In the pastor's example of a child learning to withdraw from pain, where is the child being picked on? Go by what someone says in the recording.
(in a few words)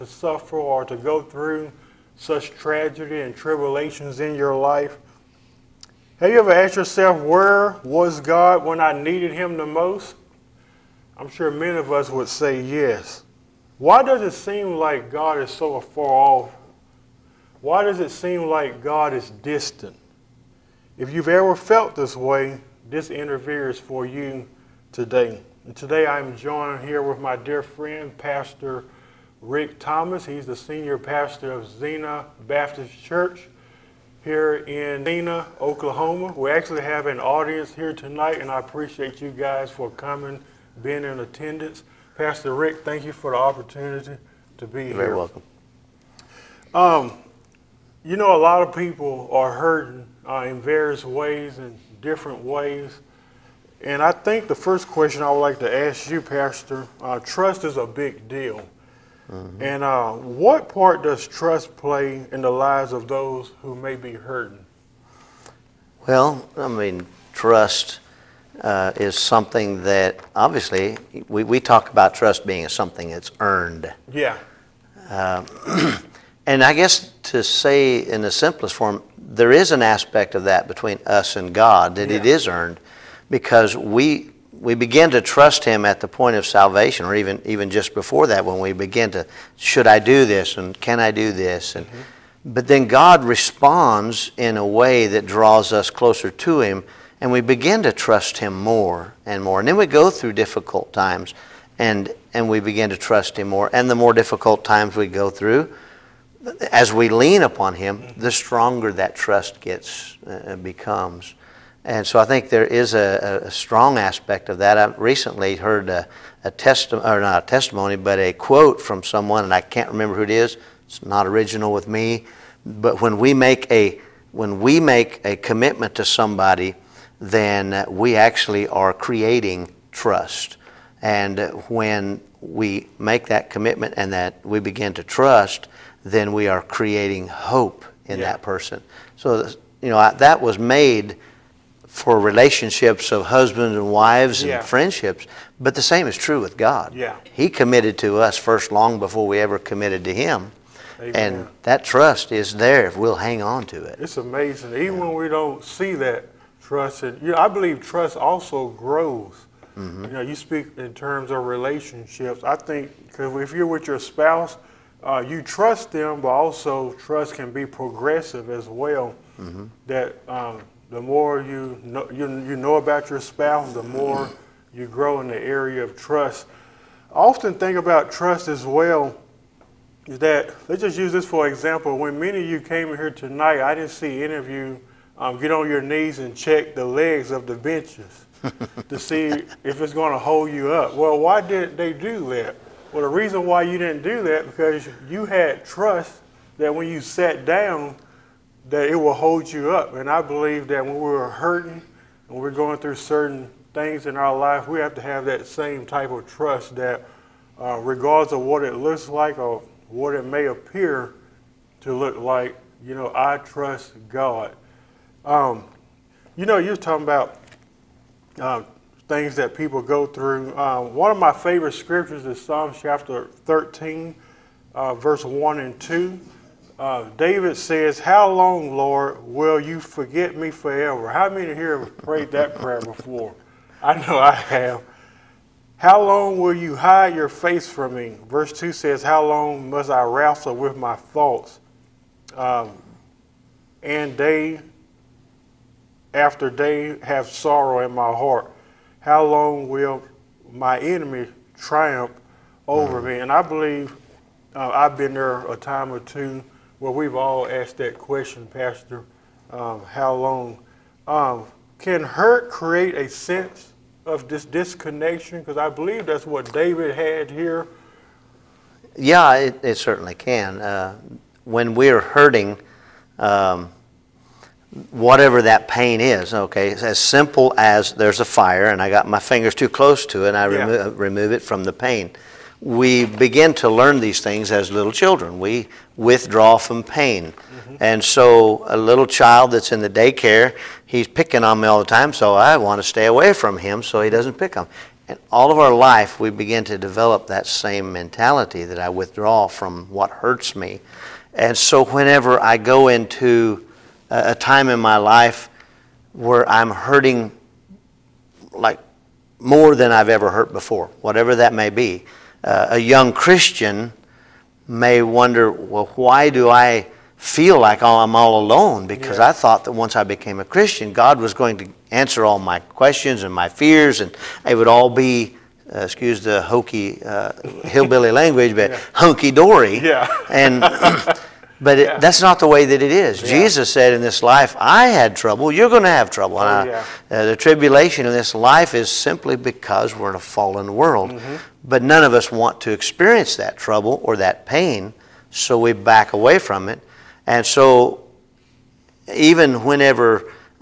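Daycare.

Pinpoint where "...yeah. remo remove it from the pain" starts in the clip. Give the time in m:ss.
4:40.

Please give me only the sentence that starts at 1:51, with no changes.
And so I think there is a, a strong aspect of that.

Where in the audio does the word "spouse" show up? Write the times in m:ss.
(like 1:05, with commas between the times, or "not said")
2:43, 2:53.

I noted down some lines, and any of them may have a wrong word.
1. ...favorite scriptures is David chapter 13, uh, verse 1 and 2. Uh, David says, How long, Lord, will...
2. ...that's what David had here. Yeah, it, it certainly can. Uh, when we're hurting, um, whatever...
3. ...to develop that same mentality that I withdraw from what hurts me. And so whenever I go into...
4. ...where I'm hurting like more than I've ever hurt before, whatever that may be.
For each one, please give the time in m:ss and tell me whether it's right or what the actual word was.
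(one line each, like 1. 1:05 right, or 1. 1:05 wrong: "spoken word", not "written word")
1. 3:41 wrong: "Psalms", not "David"
2. 4:26 right
3. 4:56 right
4. 5:06 right.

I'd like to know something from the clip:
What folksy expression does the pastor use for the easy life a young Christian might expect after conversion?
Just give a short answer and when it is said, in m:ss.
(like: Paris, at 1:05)
Hunky dory, at 5:28.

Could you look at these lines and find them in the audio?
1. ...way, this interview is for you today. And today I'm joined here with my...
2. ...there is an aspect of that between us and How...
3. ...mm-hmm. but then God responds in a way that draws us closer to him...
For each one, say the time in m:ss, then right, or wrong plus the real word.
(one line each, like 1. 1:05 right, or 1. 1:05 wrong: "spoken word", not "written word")
1. 0:22 right
2. 1:19 wrong: "God", not "How"
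3. 1:31 right.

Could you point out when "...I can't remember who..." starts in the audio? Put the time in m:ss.
1:59.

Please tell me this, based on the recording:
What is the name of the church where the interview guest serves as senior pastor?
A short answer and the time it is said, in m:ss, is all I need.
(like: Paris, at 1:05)
Zena Baptist Church, at 0:31.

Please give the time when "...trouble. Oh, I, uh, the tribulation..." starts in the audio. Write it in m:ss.
5:36.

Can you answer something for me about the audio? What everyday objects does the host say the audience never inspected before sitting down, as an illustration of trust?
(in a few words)
Benches.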